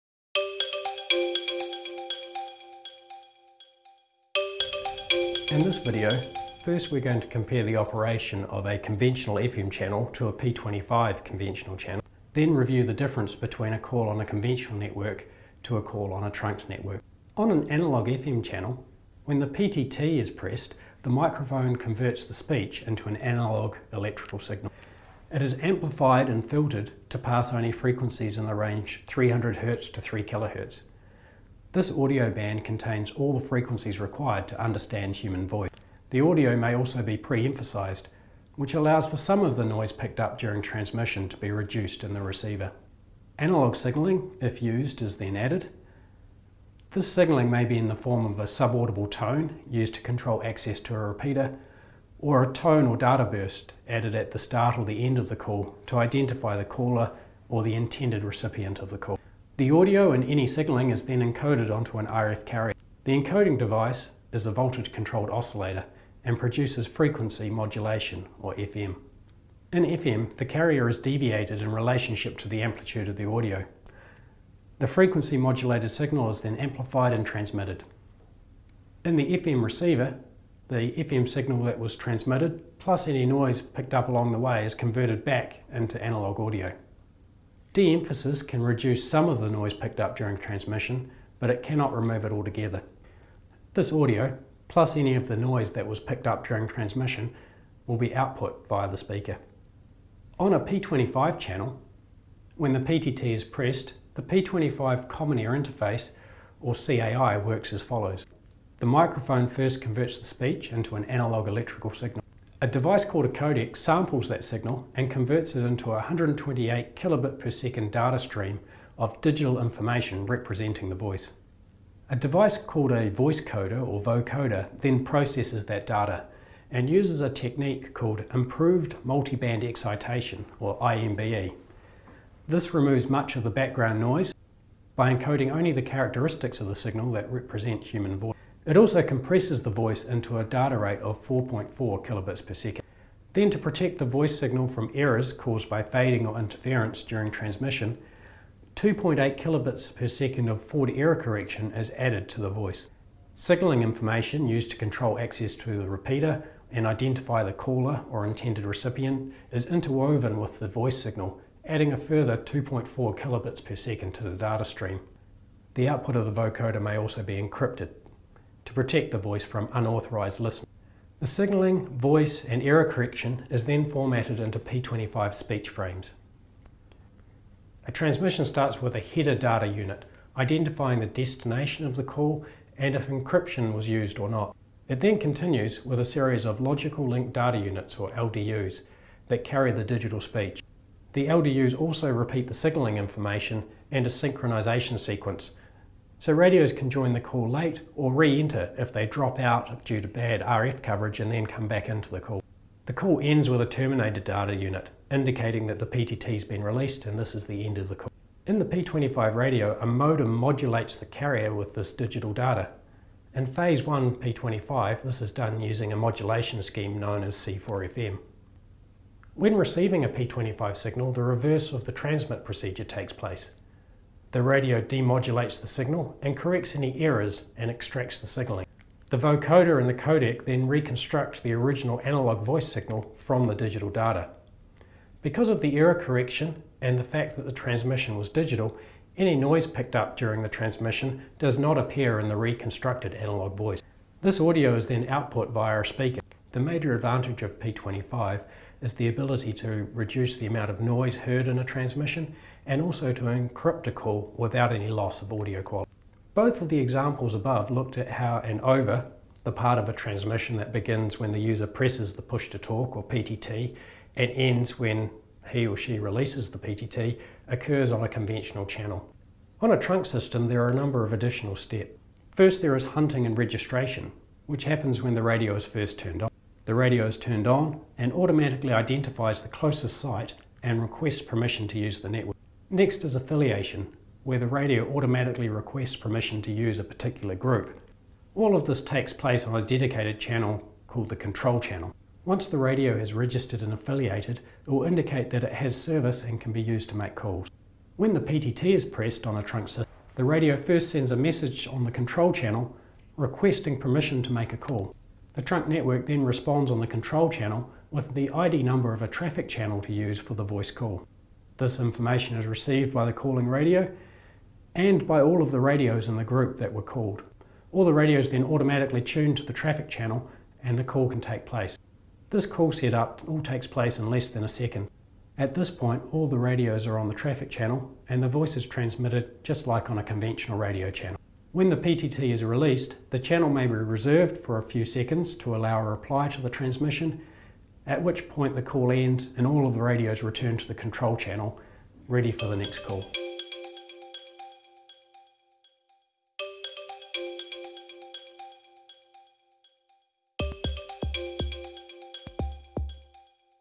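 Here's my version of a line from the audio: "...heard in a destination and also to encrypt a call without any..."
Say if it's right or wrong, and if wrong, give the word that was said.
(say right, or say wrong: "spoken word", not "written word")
wrong: "transmission", not "destination".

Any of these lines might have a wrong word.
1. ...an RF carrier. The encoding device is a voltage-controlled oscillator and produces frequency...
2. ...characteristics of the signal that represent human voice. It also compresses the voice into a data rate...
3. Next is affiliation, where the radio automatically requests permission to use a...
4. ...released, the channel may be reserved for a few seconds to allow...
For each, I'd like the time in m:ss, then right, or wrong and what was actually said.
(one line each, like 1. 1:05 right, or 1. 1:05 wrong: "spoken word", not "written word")
1. 1:01 right
2. 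2:15 right
3. 4:42 right
4. 5:32 right.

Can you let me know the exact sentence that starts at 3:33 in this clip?
In Phase 1 P25, this is done using a modulation scheme known as C4FM.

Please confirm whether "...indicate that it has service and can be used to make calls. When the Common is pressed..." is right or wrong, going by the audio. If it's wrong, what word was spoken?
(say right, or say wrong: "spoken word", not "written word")
wrong: "PTT", not "Common".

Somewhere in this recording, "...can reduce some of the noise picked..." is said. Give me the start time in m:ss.
1:28.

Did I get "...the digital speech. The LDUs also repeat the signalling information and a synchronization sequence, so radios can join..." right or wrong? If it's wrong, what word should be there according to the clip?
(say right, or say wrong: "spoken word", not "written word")
right.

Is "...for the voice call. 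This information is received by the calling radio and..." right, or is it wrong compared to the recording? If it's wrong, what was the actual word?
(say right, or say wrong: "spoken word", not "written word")
right.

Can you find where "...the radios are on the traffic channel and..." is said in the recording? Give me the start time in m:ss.
5:26.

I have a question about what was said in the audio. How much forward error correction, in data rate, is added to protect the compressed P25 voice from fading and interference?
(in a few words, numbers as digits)
2.8 kilobits per second.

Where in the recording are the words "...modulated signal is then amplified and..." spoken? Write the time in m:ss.
1:15.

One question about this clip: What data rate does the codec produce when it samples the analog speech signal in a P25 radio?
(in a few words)
128 kilobits per second.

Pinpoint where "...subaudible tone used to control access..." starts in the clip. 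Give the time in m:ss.
0:48.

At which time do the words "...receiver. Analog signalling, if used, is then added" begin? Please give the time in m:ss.
0:42.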